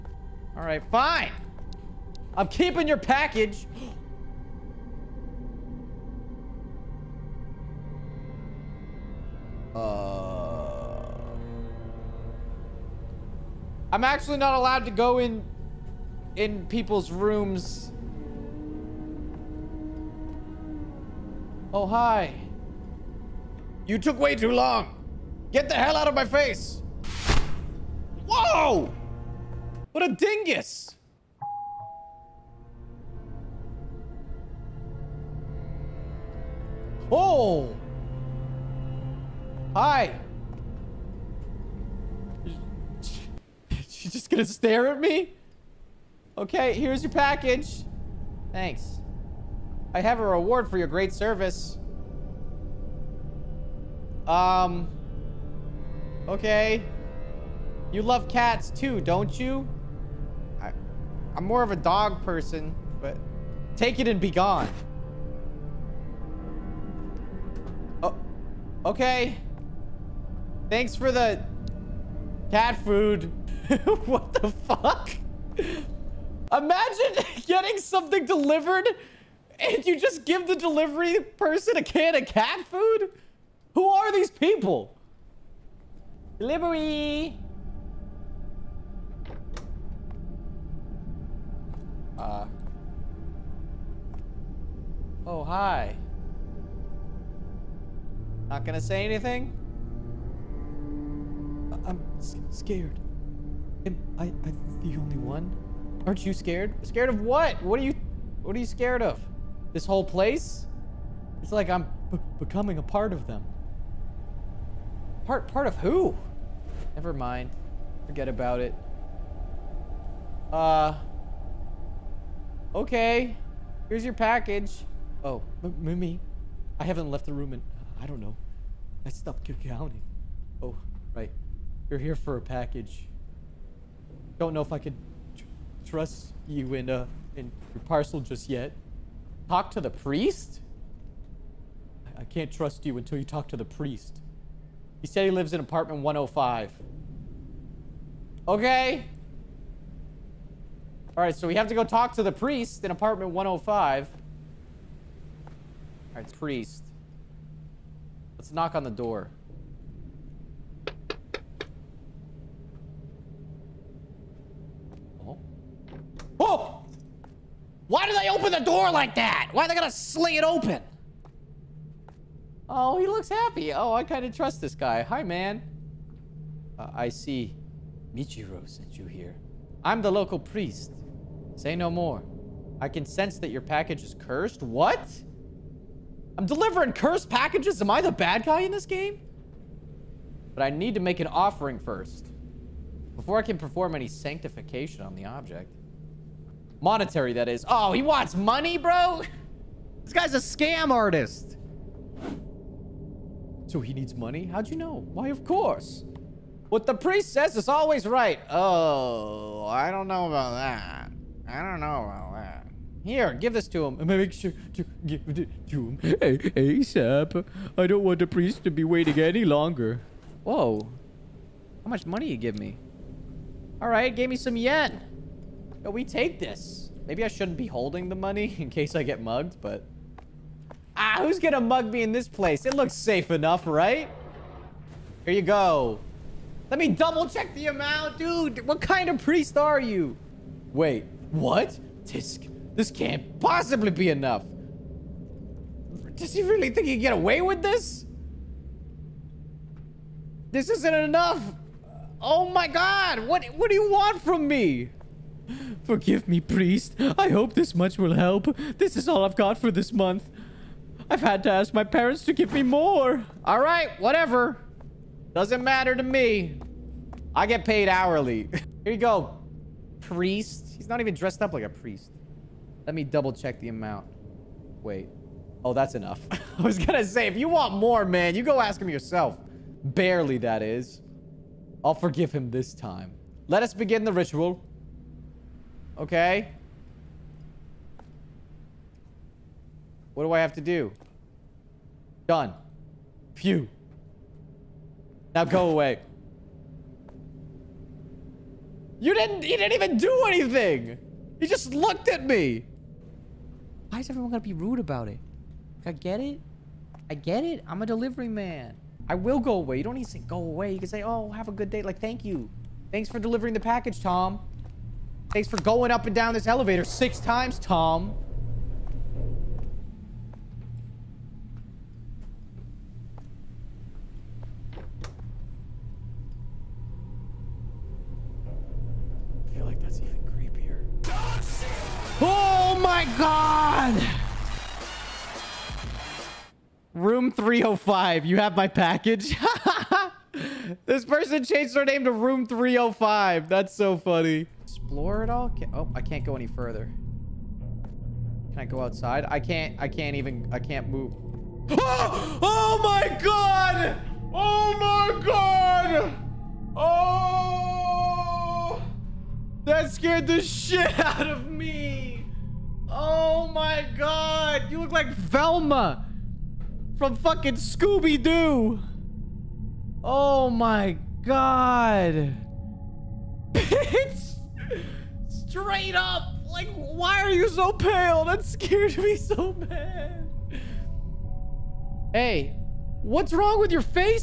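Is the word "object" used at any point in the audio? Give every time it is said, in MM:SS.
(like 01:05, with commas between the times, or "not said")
03:15.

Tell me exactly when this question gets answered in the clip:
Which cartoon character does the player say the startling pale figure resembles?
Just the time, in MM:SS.
06:05.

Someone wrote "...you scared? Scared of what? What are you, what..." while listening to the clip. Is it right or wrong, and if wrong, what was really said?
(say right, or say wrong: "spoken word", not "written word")
right.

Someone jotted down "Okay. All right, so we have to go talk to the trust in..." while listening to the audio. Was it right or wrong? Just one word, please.
wrong.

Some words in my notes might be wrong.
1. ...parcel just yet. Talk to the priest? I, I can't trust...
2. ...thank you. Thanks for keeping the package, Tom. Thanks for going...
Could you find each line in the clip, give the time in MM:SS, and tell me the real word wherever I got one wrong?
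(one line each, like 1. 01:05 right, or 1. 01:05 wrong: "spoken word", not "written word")
1. 02:17 right
2. 05:12 wrong: "delivering", not "keeping".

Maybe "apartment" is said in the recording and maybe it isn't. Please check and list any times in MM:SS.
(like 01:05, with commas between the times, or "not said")
02:25, 02:32.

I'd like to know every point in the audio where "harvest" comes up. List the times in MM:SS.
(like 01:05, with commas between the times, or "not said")
not said.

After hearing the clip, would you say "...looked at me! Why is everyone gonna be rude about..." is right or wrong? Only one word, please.
right.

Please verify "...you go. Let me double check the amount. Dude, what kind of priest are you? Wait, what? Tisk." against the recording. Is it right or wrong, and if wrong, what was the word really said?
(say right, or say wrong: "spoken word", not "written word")
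right.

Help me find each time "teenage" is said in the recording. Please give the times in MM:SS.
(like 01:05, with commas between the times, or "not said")
not said.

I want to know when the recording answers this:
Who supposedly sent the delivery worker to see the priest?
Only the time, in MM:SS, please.
02:58.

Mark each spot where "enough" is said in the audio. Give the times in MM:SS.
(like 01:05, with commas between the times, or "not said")
03:53, 04:04, 04:10, 04:35.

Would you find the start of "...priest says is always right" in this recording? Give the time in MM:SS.
03:26.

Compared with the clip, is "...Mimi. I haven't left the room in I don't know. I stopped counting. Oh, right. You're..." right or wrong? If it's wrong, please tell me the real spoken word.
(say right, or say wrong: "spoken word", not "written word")
right.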